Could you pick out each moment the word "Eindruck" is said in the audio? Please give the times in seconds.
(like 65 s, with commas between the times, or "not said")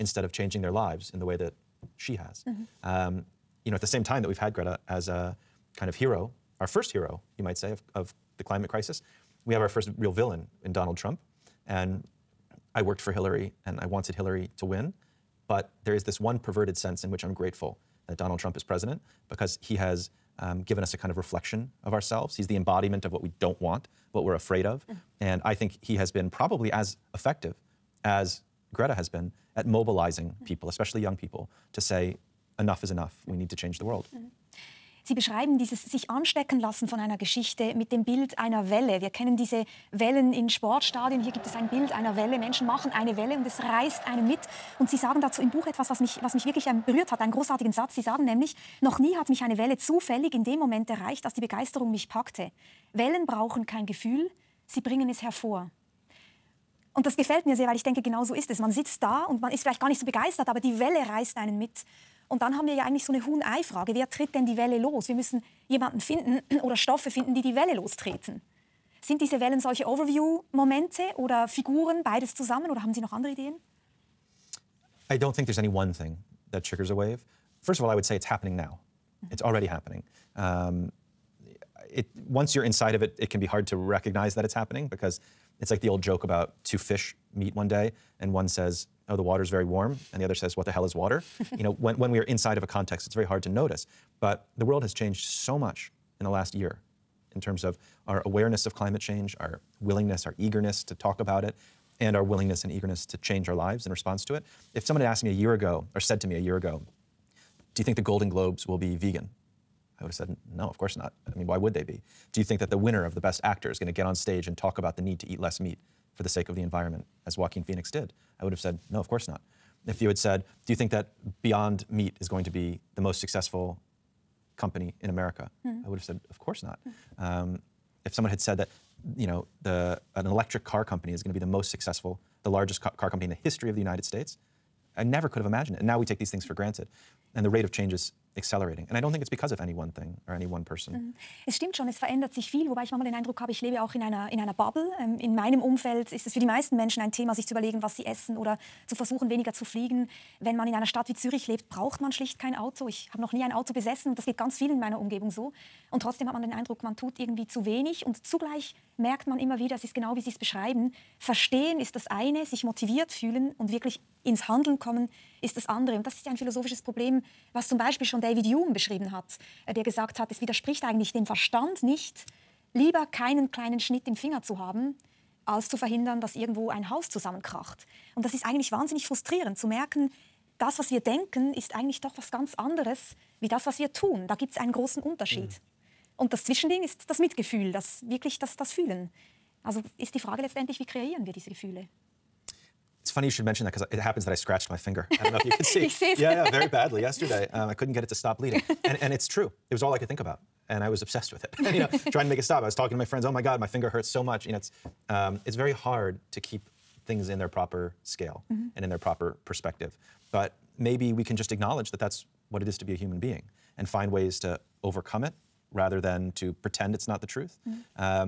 143 s, 156 s.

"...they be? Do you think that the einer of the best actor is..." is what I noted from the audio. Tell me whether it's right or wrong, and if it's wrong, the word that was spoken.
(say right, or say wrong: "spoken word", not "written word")
wrong: "winner", not "einer".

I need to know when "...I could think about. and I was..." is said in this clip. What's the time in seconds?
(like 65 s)
199 s.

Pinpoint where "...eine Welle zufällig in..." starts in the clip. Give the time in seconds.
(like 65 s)
49 s.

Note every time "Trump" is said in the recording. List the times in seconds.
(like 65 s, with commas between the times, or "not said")
10 s, 18 s.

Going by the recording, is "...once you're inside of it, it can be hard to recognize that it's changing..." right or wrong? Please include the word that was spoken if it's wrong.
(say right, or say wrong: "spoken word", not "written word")
wrong: "happening", not "changing".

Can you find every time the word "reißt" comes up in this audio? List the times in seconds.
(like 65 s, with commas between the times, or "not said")
43 s, 61 s.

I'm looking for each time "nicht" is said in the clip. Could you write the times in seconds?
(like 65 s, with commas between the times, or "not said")
59 s, 171 s.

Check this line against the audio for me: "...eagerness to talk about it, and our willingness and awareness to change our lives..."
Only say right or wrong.
wrong.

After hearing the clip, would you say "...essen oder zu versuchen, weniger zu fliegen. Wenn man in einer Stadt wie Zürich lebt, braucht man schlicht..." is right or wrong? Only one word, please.
right.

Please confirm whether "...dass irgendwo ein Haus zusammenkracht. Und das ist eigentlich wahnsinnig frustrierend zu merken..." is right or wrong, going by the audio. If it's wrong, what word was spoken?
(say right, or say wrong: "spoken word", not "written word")
right.